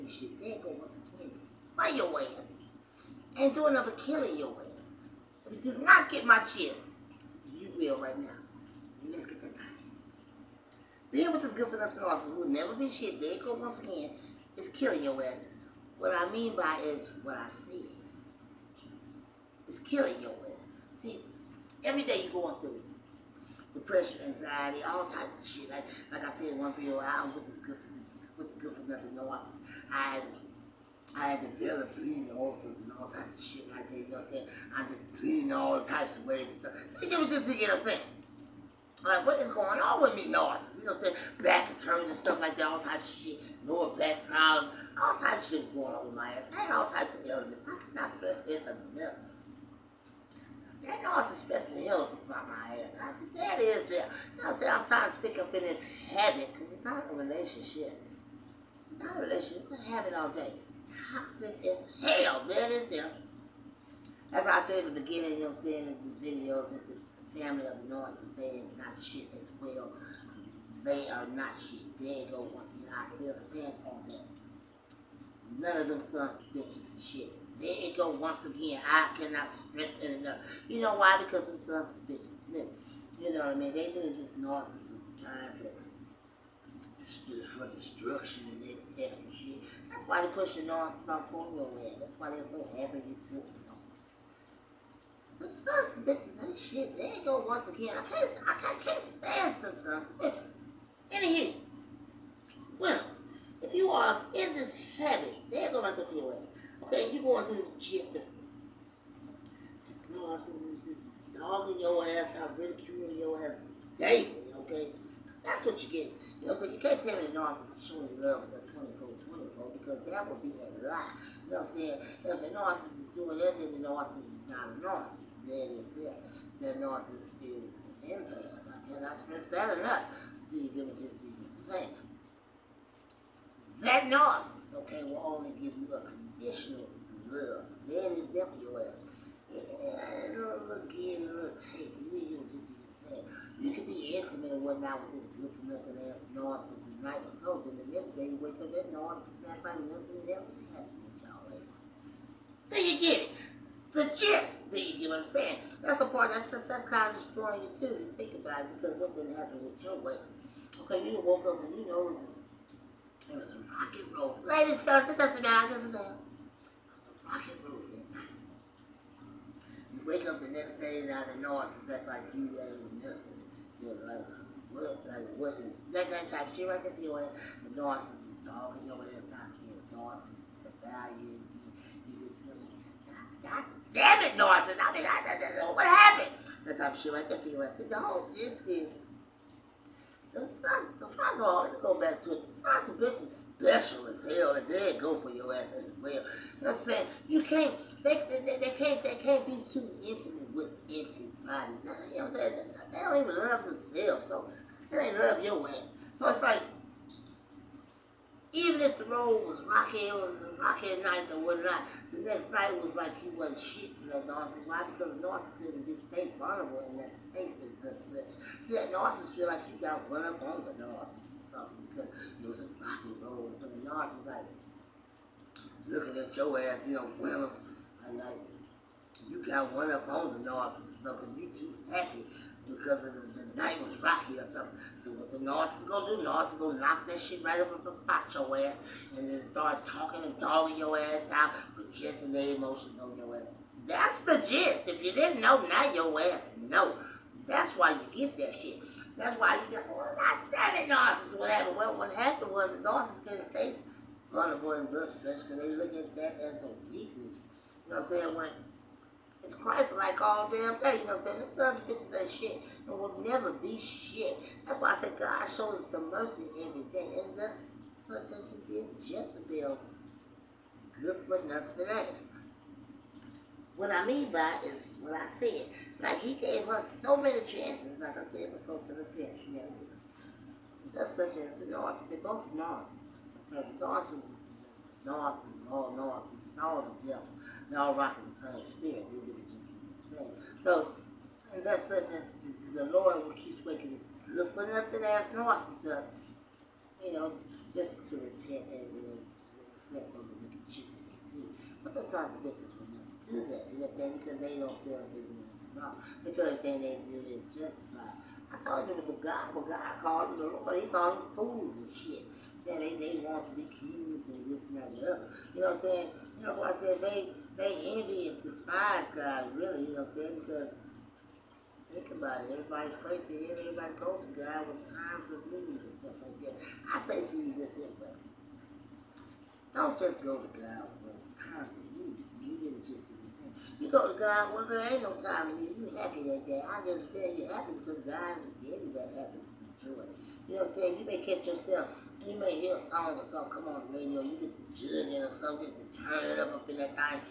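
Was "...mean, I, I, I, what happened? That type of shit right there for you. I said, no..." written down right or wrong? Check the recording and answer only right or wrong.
right.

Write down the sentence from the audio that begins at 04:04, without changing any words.
If you didn't know, now your ass know.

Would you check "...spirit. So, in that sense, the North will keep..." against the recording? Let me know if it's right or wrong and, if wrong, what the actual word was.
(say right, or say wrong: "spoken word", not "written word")
wrong: "Lord", not "North".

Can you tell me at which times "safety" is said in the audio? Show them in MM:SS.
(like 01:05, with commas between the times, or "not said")
not said.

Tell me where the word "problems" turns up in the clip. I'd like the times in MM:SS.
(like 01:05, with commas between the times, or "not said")
00:44.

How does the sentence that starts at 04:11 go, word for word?
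Well, what happened was the Narcissus can not stay vulnerable and good such because they look at that as a weakness.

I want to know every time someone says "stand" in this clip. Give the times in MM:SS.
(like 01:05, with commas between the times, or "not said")
01:13, 01:39.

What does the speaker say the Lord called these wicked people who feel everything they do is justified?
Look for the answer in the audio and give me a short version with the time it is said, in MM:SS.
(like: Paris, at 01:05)
Fools, at 05:11.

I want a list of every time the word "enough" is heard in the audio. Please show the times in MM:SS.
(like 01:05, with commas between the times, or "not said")
00:48, 01:20, 02:09.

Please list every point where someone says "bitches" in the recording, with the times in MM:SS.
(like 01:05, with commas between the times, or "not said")
01:16, 01:22, 01:36, 01:40, 03:12, 04:22, 05:02.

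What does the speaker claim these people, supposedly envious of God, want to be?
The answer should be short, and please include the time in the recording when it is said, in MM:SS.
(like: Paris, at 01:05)
Kings, at 05:13.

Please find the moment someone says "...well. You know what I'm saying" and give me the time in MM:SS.
03:16.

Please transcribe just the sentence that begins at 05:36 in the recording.
I just tell you happy because God gave you that happiness and joy.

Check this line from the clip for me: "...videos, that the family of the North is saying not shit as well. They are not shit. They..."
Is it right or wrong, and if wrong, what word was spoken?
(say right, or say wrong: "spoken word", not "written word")
right.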